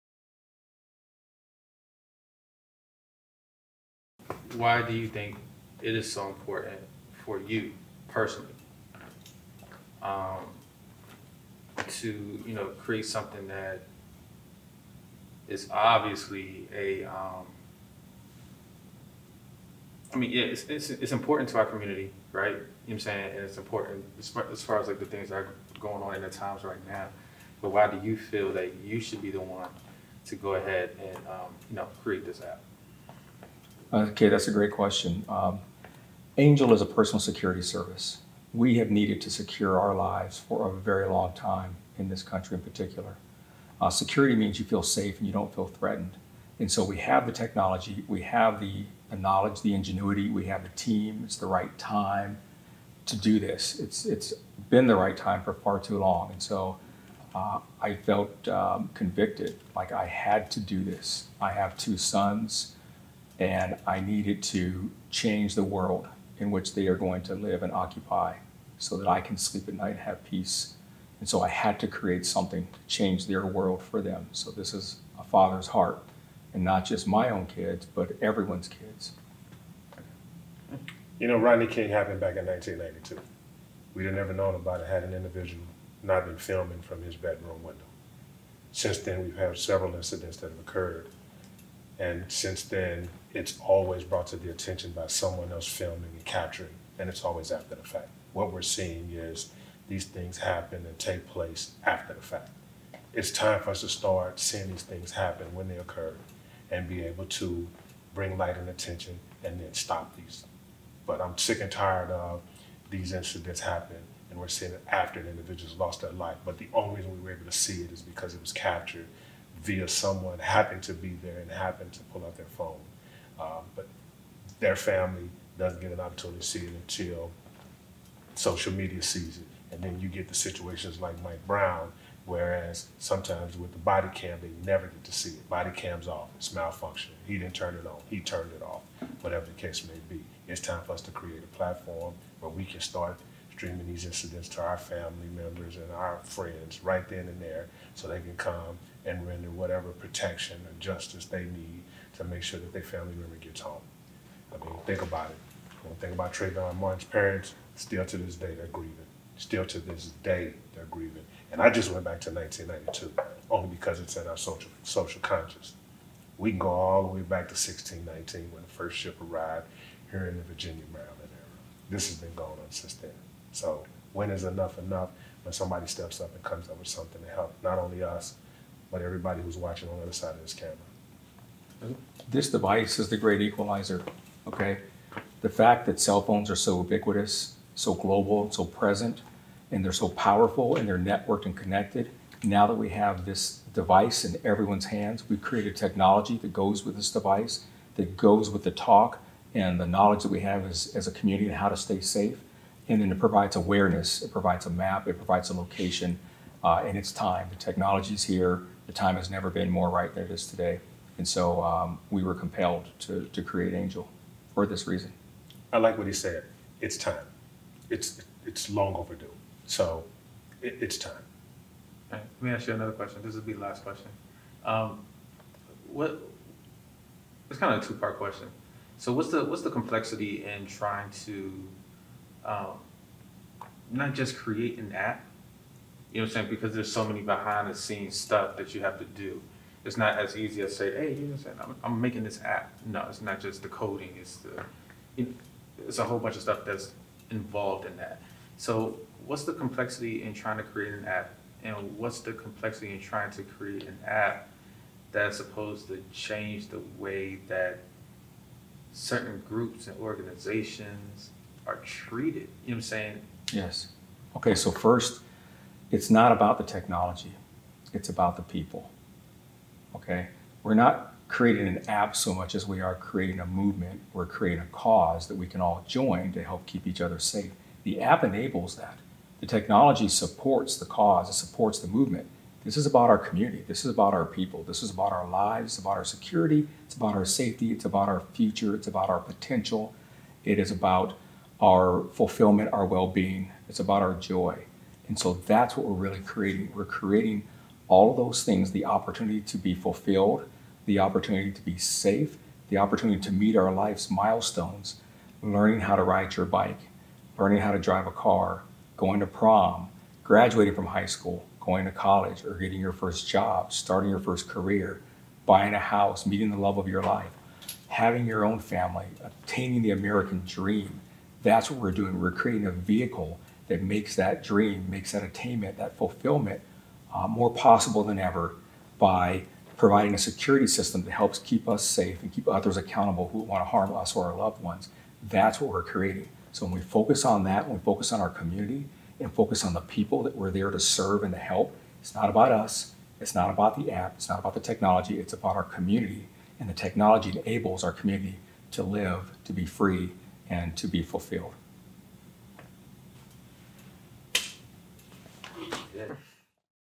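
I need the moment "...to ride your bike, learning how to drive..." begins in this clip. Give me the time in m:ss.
5:05.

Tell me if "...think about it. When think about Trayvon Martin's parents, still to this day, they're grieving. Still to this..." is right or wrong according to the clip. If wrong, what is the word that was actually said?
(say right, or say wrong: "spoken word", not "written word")
right.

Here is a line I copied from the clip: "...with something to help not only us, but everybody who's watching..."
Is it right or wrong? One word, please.
right.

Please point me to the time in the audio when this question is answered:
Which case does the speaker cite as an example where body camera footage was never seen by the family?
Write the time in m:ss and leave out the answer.
2:11.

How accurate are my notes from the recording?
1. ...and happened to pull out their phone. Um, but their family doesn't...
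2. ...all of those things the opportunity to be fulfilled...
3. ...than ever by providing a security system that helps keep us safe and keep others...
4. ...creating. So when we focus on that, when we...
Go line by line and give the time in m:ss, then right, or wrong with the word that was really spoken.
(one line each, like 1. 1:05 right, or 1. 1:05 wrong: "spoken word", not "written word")
1. 2:01 right
2. 4:57 right
3. 5:28 right
4. 5:35 right.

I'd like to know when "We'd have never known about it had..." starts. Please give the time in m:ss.
1:23.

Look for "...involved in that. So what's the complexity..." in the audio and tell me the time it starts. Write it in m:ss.
4:07.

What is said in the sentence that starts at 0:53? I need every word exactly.
It's, it's been the right time for far too long.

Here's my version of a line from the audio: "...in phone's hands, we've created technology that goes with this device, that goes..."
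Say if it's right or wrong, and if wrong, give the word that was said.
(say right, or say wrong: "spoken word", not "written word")
wrong: "everyone", not "phone".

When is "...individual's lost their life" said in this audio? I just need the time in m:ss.
1:55.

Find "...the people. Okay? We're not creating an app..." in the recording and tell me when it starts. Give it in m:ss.
4:28.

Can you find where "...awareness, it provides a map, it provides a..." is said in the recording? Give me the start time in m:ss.
3:23.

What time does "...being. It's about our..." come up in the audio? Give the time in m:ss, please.
4:53.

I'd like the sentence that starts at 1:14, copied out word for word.
So this is a father's heart, and not just my own kids, but everyone's kids.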